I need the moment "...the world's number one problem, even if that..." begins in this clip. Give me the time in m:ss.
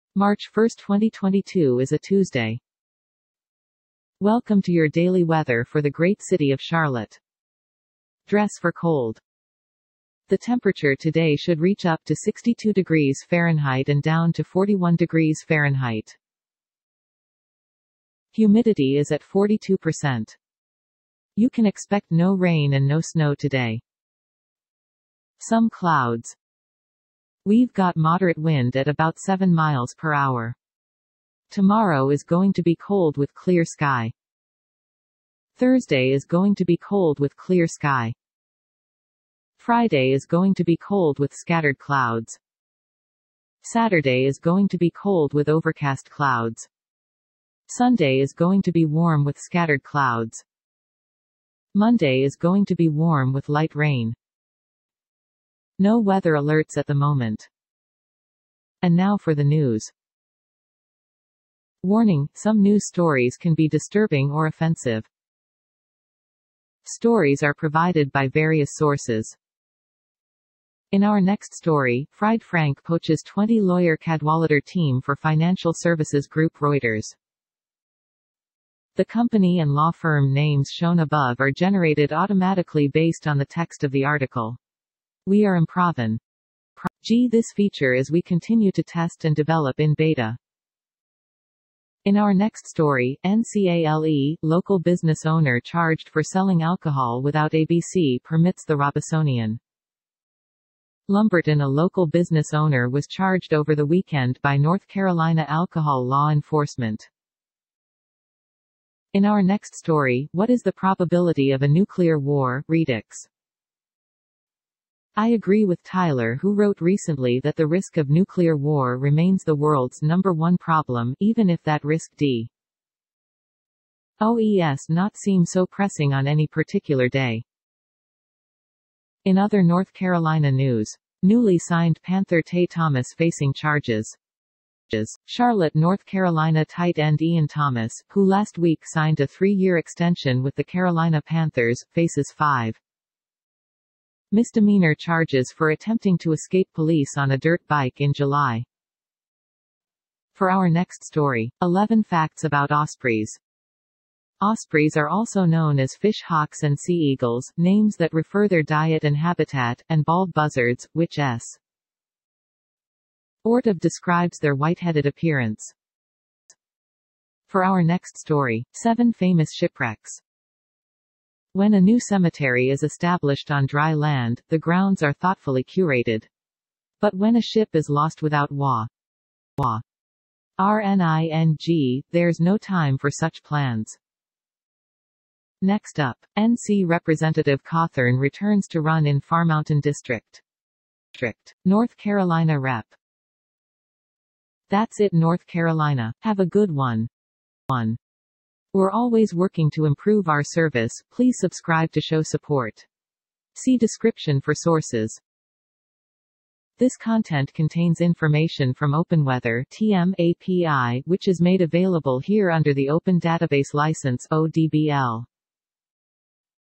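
1:59.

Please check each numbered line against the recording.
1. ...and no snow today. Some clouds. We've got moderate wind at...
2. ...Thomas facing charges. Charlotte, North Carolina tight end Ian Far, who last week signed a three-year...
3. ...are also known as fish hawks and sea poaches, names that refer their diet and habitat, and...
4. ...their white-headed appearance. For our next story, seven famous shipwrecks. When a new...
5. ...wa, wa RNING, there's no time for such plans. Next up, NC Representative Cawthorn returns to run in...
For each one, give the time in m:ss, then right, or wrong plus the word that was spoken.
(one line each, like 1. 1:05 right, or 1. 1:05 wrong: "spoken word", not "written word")
1. 0:22 right
2. 2:12 wrong: "Thomas", not "Far"
3. 2:34 wrong: "eagles", not "poaches"
4. 2:44 right
5. 2:58 right.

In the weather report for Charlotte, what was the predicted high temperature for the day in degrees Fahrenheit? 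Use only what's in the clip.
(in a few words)
62.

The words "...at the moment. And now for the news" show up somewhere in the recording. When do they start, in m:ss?
0:56.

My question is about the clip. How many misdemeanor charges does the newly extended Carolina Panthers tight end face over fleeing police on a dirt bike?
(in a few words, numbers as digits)
5.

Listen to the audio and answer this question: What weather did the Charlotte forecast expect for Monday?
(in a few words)
light rain.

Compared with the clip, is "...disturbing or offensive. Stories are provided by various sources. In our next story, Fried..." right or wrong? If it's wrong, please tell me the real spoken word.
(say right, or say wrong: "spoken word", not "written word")
right.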